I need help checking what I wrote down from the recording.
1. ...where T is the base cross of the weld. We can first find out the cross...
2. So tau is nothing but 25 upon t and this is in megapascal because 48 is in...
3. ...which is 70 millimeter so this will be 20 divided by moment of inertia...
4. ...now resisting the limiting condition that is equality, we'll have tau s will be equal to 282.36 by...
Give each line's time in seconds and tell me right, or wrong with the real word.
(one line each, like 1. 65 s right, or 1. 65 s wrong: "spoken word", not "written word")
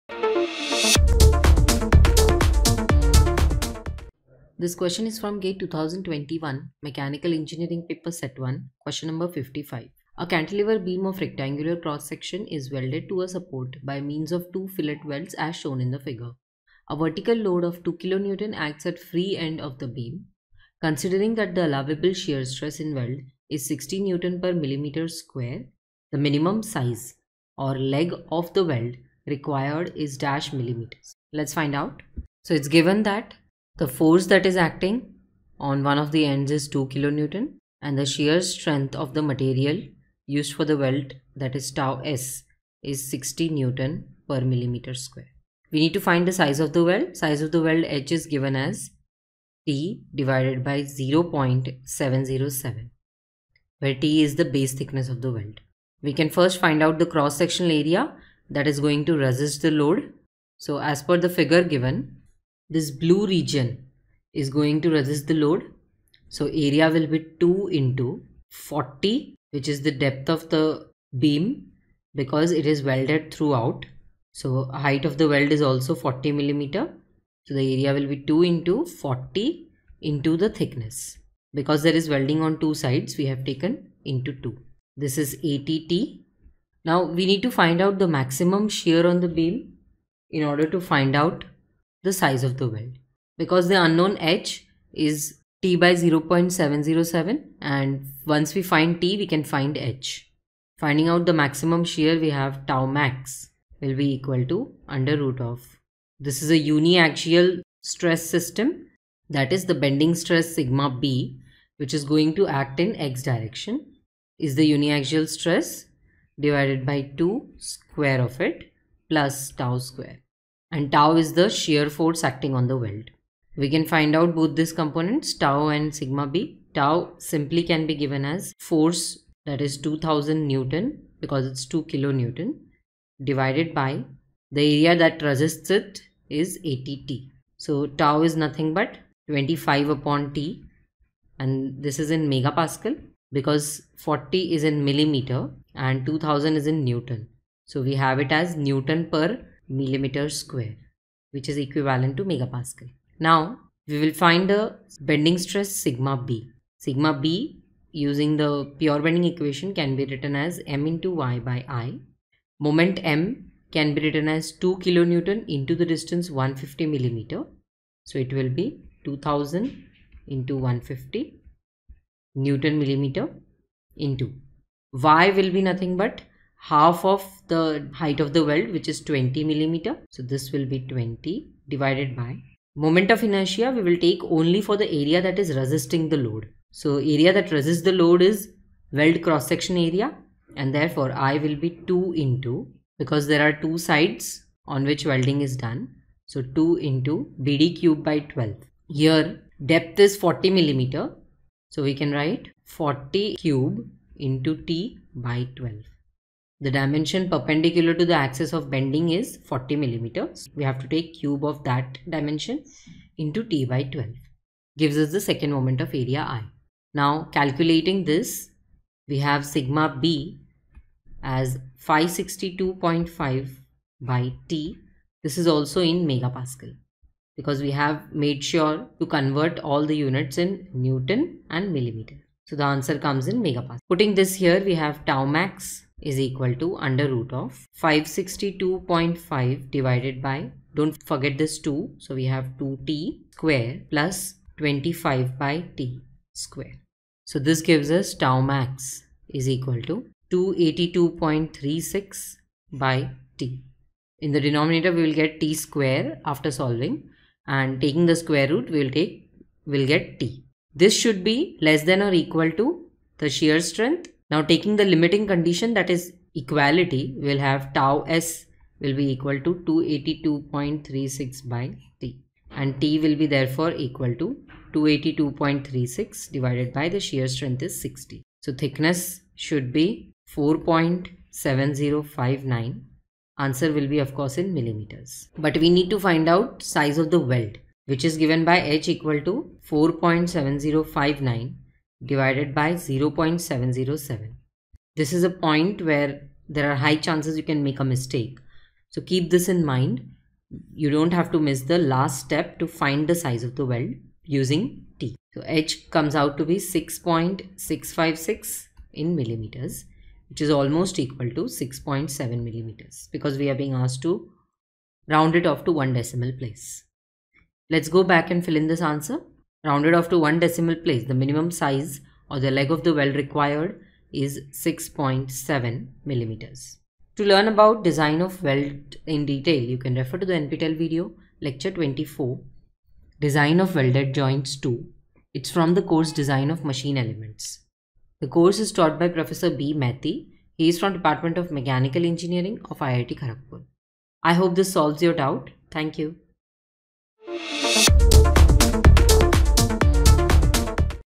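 1. 53 s wrong: "thickness", not "cross"
2. 137 s wrong: "40", not "48"
3. 178 s wrong: "20", not "70"
4. 264 s wrong: "taking", not "resisting".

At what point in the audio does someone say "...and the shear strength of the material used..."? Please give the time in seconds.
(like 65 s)
37 s.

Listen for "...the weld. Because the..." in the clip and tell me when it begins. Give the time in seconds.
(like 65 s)
92 s.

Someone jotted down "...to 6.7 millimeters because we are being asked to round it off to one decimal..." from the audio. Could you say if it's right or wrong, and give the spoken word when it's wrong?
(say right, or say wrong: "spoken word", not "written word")
right.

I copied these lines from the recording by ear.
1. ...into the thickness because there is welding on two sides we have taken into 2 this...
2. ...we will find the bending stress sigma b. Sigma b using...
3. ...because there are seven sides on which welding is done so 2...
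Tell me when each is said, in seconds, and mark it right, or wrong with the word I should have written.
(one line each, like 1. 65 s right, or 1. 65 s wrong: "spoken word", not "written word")
1. 80 s right
2. 153 s right
3. 192 s wrong: "two", not "seven".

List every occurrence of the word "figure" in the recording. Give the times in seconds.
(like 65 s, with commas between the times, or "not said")
15 s, 61 s.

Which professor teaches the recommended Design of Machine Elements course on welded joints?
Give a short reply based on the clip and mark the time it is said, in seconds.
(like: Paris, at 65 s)
B. Maiti, at 339 s.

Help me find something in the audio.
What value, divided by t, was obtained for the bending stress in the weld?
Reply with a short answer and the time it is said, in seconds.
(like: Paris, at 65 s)
562.5, at 221 s.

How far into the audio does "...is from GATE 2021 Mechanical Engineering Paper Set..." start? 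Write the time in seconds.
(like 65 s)
5 s.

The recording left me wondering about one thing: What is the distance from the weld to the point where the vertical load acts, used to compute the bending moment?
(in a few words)
150 millimeters.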